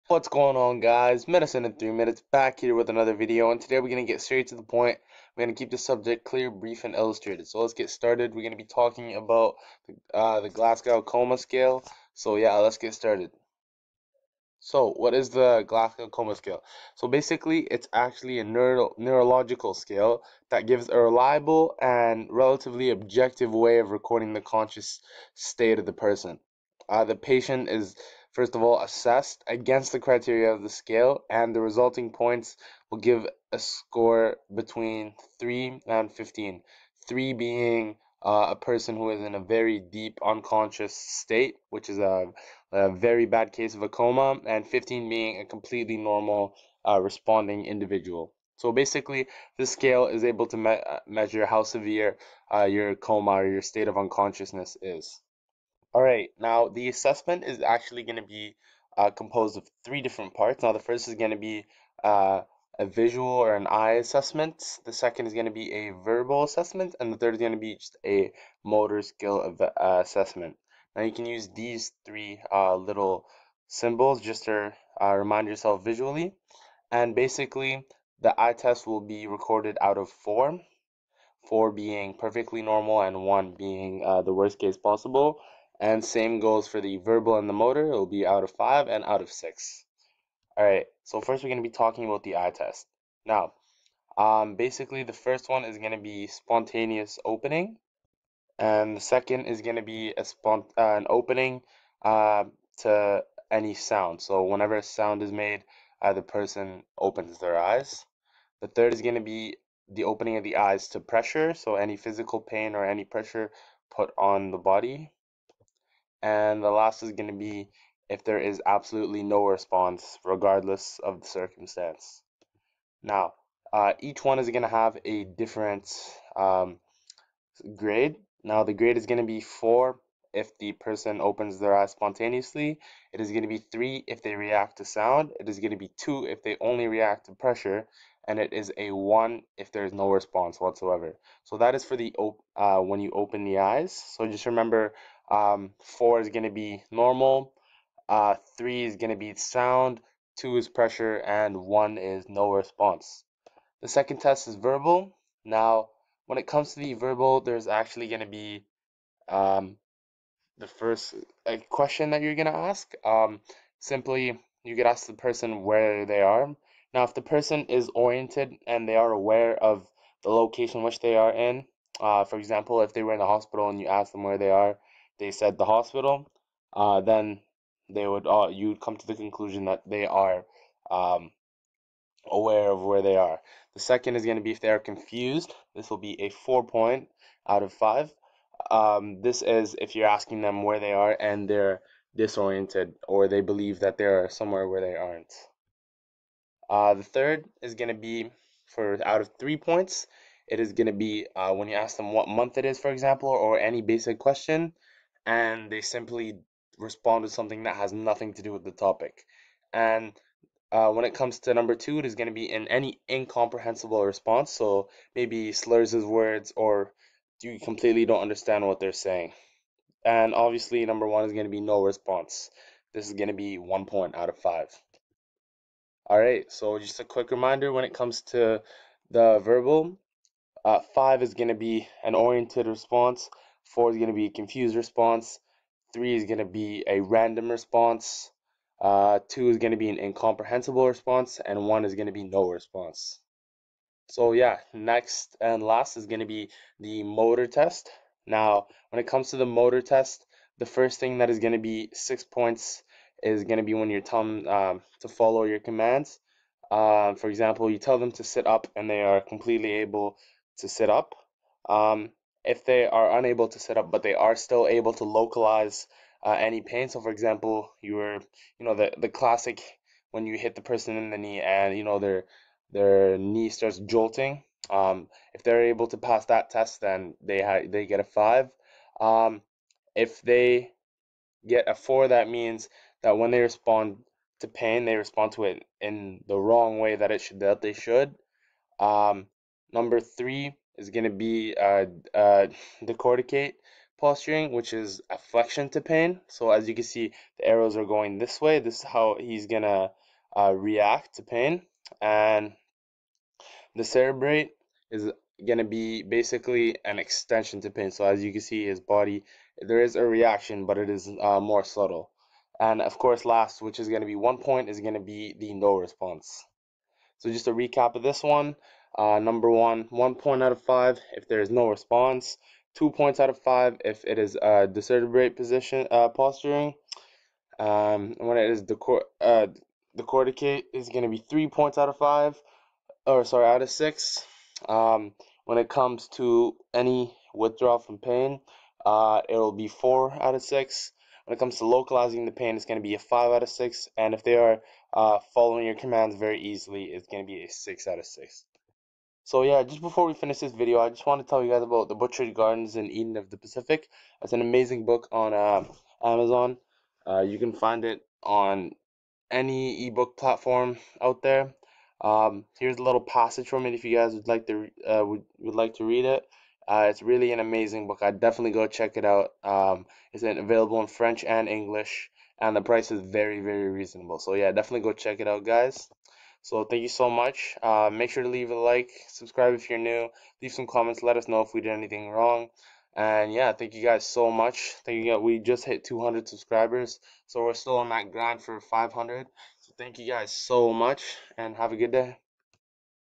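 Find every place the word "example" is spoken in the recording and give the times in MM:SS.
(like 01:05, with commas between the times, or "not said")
02:52, 03:22, 04:17, 04:27.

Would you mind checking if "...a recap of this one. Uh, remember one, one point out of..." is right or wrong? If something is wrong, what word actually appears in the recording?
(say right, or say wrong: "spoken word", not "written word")
wrong: "number", not "remember".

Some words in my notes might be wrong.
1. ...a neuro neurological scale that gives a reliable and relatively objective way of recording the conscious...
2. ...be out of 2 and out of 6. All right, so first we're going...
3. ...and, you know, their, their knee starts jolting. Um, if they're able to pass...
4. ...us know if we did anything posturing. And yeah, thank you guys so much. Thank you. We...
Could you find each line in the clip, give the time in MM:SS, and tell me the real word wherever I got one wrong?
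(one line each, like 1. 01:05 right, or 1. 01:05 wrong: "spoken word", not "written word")
1. 00:18 right
2. 01:28 wrong: "5", not "2"
3. 04:31 right
4. 06:21 wrong: "wrong", not "posturing".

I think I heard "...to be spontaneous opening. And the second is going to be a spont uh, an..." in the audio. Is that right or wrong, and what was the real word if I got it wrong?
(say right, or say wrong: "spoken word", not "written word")
right.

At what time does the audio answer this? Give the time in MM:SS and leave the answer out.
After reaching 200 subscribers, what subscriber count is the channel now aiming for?
06:28.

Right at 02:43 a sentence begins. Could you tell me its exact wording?
Um, simply, you could ask the person where they are.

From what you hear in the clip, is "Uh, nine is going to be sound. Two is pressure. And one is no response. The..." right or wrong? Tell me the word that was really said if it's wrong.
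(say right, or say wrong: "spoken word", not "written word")
wrong: "three", not "nine".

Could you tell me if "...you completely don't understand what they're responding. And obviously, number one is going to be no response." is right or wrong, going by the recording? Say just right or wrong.
wrong.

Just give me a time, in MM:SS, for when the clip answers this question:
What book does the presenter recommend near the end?
05:51.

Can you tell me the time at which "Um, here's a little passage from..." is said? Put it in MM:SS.
06:02.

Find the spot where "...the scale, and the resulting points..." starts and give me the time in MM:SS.
00:30.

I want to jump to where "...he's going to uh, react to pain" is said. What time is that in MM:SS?
04:59.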